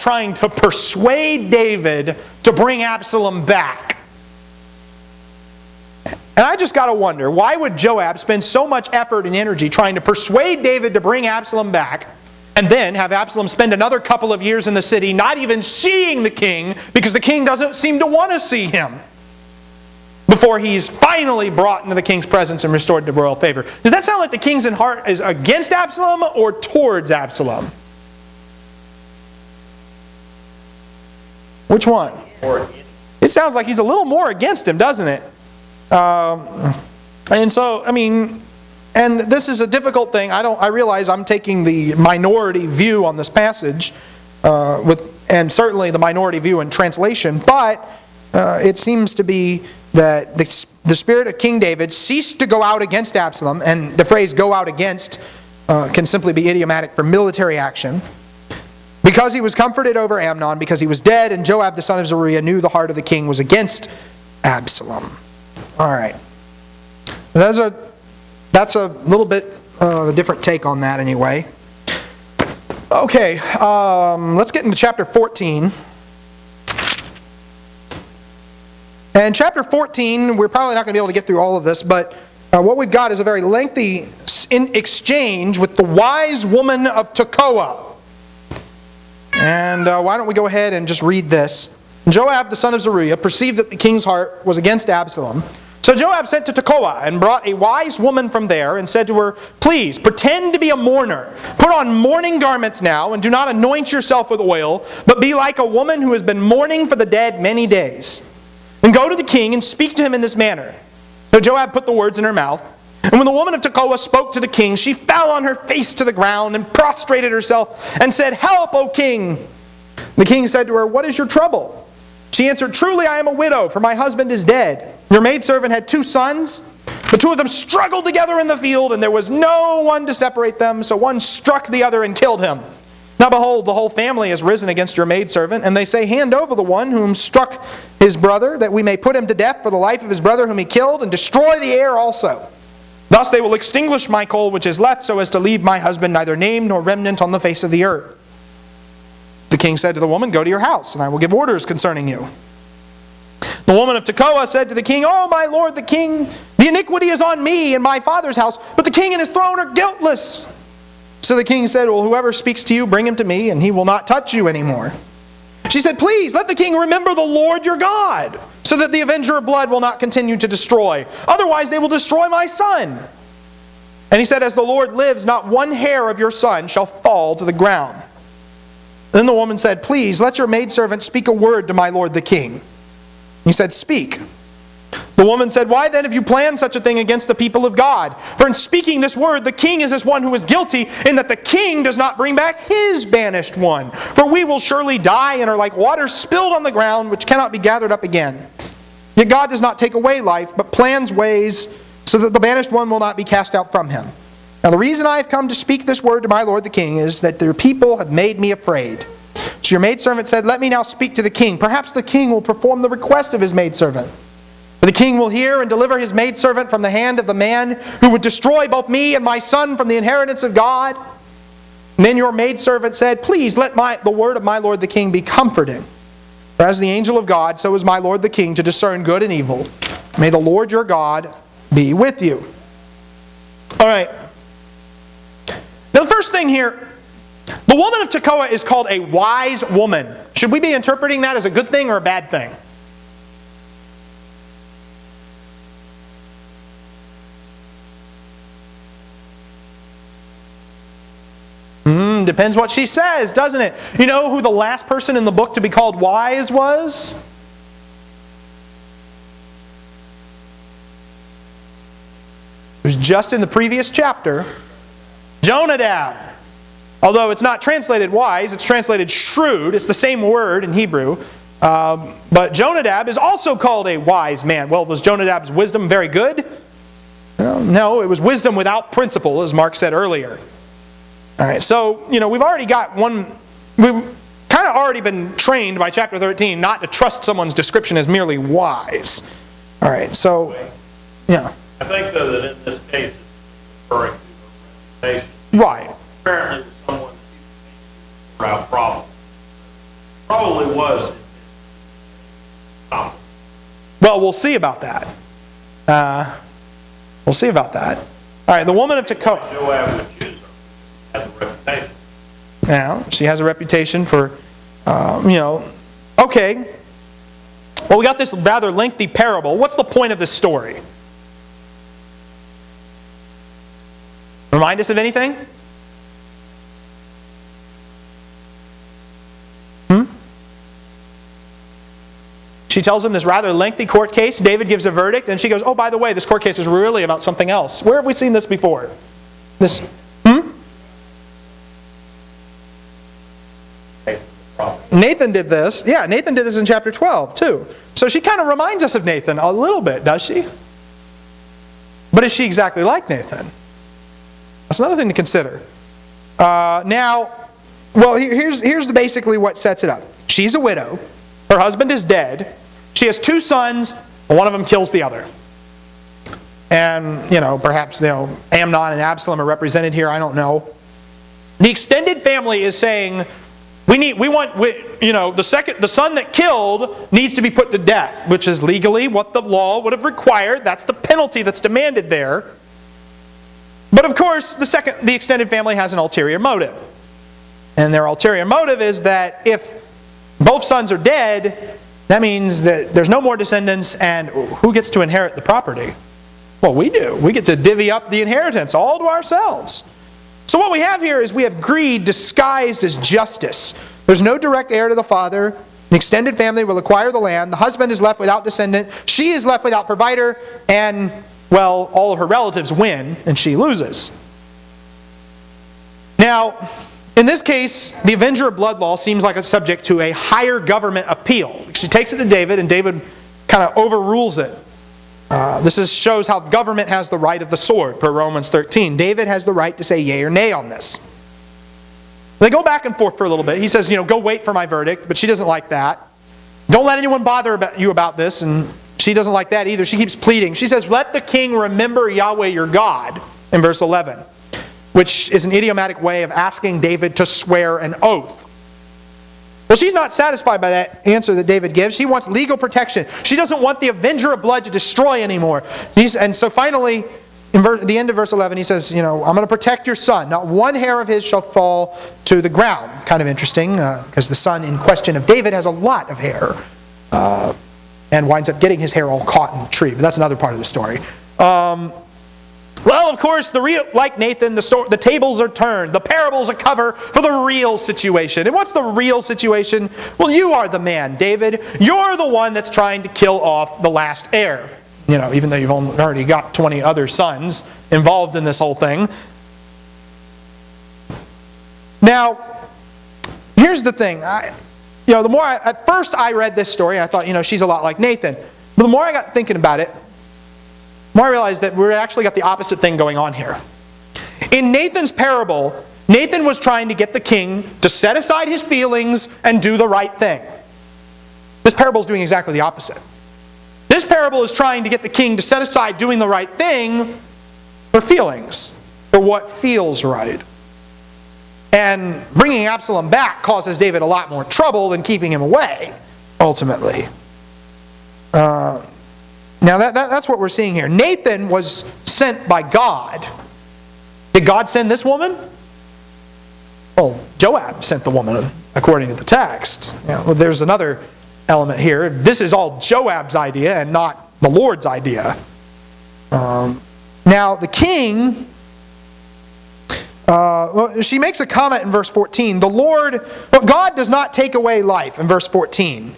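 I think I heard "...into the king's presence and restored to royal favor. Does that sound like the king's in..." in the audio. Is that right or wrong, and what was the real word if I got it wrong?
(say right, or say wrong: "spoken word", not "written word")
right.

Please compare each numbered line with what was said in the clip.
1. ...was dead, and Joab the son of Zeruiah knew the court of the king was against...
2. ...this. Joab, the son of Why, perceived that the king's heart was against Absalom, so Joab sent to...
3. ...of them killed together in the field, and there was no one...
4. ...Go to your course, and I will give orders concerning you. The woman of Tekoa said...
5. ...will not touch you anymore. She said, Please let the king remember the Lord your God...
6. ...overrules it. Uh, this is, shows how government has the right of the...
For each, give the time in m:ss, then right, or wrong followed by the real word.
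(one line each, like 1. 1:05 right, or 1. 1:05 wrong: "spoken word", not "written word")
1. 1:00 wrong: "heart", not "court"
2. 1:31 wrong: "Zeruiah", not "Why"
3. 2:07 wrong: "struggled", not "killed"
4. 2:30 wrong: "house", not "course"
5. 2:43 right
6. 7:03 right.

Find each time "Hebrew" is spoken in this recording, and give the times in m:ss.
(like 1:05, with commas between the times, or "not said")
4:30.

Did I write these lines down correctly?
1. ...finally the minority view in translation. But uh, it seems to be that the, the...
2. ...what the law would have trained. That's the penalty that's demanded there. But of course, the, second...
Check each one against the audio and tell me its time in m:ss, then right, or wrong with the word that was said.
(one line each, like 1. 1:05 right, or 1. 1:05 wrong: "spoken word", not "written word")
1. 0:45 wrong: "certainly", not "finally"
2. 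6:19 wrong: "required", not "trained".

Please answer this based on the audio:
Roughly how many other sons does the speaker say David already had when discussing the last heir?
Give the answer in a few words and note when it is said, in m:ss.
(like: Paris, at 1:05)
20, at 8:06.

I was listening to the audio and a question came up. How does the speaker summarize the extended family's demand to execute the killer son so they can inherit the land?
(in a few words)
greed disguised as justice.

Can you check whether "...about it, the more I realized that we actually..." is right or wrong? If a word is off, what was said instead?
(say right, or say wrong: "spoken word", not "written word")
right.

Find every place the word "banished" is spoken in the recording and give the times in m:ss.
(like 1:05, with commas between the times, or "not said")
3:13, 3:22.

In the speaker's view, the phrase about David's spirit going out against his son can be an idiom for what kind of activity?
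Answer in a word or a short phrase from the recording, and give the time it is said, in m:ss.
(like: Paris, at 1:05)
military action, at 0:57.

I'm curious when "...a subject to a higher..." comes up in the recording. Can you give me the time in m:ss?
6:59.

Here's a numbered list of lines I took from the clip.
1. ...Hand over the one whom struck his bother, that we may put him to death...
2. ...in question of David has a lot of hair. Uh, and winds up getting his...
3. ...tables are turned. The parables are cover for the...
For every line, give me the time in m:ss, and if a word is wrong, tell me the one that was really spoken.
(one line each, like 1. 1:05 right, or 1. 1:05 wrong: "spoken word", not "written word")
1. 2:16 wrong: "brother", not "bother"
2. 7:44 right
3. 7:54 right.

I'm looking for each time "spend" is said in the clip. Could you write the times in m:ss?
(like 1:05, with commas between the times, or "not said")
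0:08, 0:13.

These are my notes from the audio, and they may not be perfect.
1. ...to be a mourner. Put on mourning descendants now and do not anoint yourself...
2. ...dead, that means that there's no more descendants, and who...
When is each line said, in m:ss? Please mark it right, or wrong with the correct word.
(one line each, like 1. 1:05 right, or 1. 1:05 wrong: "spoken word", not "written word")
1. 1:40 wrong: "garments", not "descendants"
2. 6:30 right.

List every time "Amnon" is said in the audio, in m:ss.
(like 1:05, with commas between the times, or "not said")
1:00, 6:08.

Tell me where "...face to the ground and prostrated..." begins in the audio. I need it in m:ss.
1:55.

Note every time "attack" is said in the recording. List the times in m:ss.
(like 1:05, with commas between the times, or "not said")
not said.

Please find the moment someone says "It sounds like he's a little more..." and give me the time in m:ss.
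0:33.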